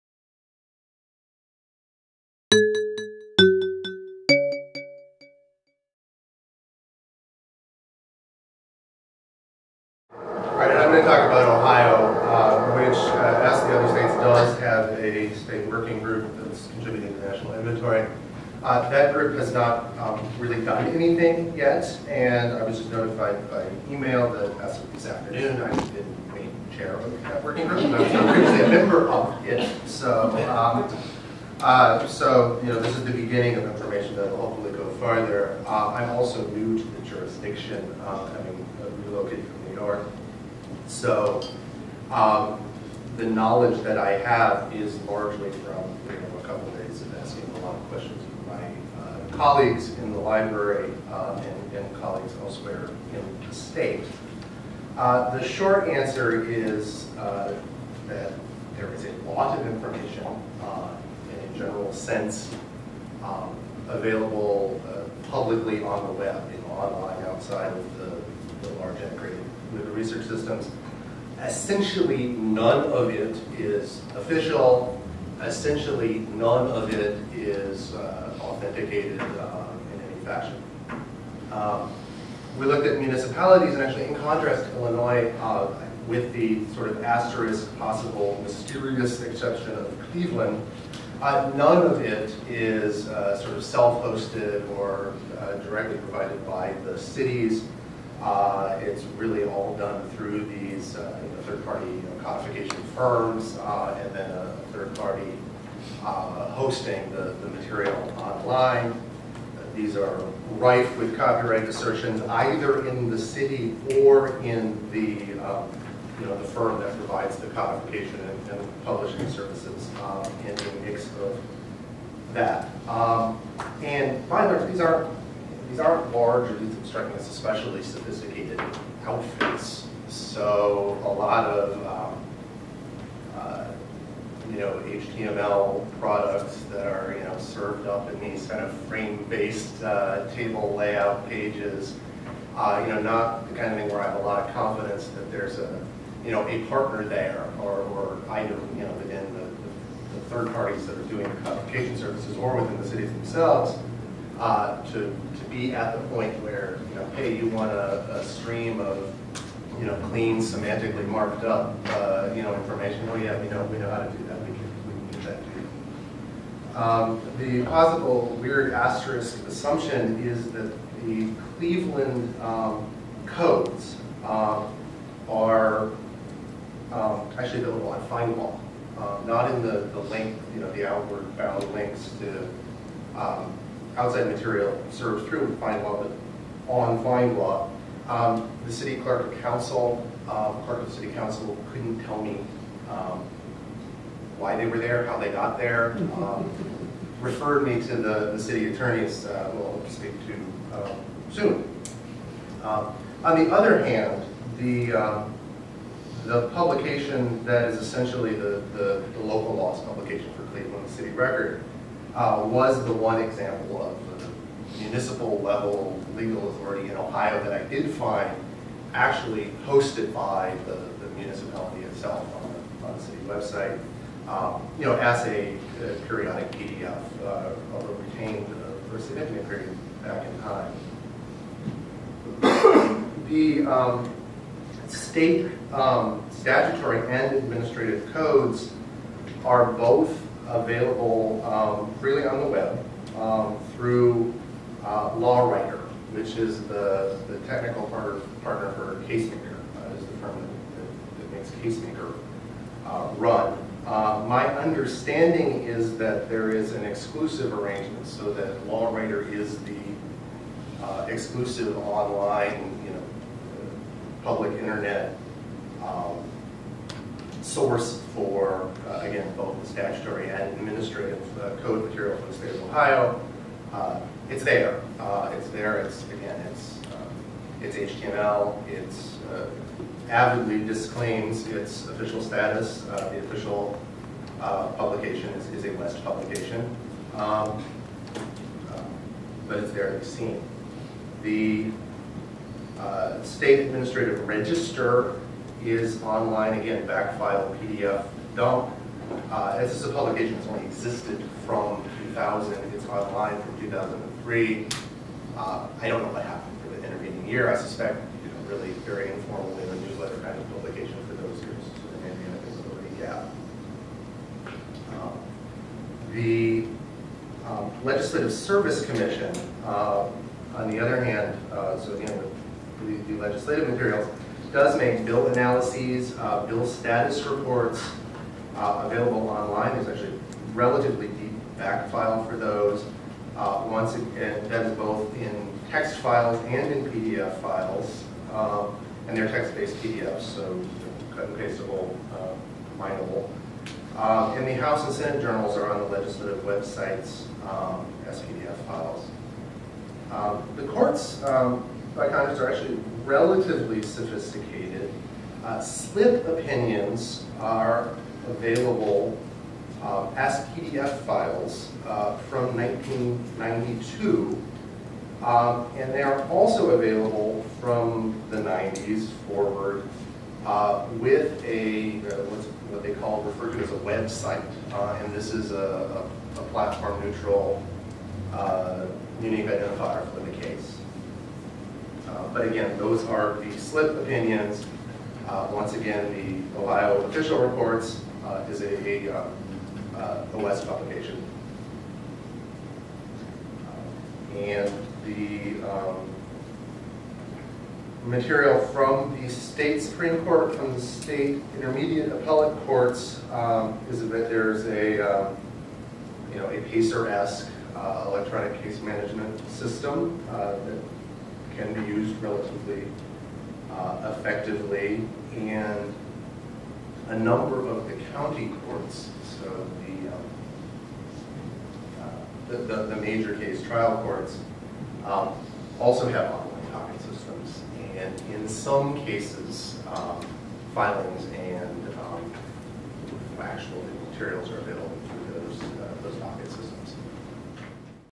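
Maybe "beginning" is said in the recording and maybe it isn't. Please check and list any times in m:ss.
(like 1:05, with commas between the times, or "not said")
0:33.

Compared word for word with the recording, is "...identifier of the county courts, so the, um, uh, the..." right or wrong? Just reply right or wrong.
wrong.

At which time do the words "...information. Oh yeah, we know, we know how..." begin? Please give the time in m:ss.
2:42.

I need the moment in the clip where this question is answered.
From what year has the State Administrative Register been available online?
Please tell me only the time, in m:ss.
5:03.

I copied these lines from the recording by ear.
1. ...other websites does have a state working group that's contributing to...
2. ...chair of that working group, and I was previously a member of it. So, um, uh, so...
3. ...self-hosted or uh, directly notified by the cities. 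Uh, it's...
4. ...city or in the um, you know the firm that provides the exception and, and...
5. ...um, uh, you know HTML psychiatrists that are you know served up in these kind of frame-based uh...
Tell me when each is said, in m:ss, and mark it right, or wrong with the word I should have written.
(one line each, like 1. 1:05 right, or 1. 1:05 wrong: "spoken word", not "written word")
1. 0:13 wrong: "states", not "websites"
2. 0:26 right
3. 1:33 wrong: "provided", not "notified"
4. 1:53 wrong: "codification", not "exception"
5. 2:12 wrong: "products", not "psychiatrists".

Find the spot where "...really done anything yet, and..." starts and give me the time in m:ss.
0:20.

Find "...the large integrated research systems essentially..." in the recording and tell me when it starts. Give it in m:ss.
1:08.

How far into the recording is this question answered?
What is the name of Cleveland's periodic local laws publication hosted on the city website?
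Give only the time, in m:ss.
3:30.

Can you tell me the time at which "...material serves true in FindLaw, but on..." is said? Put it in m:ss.
3:04.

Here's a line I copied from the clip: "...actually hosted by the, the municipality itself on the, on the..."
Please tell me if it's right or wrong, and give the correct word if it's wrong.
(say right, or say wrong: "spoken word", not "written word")
right.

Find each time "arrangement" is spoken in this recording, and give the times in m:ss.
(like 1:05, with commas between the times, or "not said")
4:17.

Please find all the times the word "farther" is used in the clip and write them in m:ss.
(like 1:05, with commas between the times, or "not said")
0:34.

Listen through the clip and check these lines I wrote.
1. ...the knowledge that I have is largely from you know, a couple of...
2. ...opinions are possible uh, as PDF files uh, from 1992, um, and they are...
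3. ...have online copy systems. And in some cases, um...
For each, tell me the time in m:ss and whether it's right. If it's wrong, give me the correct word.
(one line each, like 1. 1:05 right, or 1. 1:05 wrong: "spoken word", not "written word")
1. 0:43 right
2. 5:56 wrong: "available", not "possible"
3. 7:06 right.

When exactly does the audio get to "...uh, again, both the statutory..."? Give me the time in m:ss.
4:28.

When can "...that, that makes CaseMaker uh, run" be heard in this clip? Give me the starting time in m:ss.
4:11.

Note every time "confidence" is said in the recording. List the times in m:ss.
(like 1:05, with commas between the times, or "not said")
2:24.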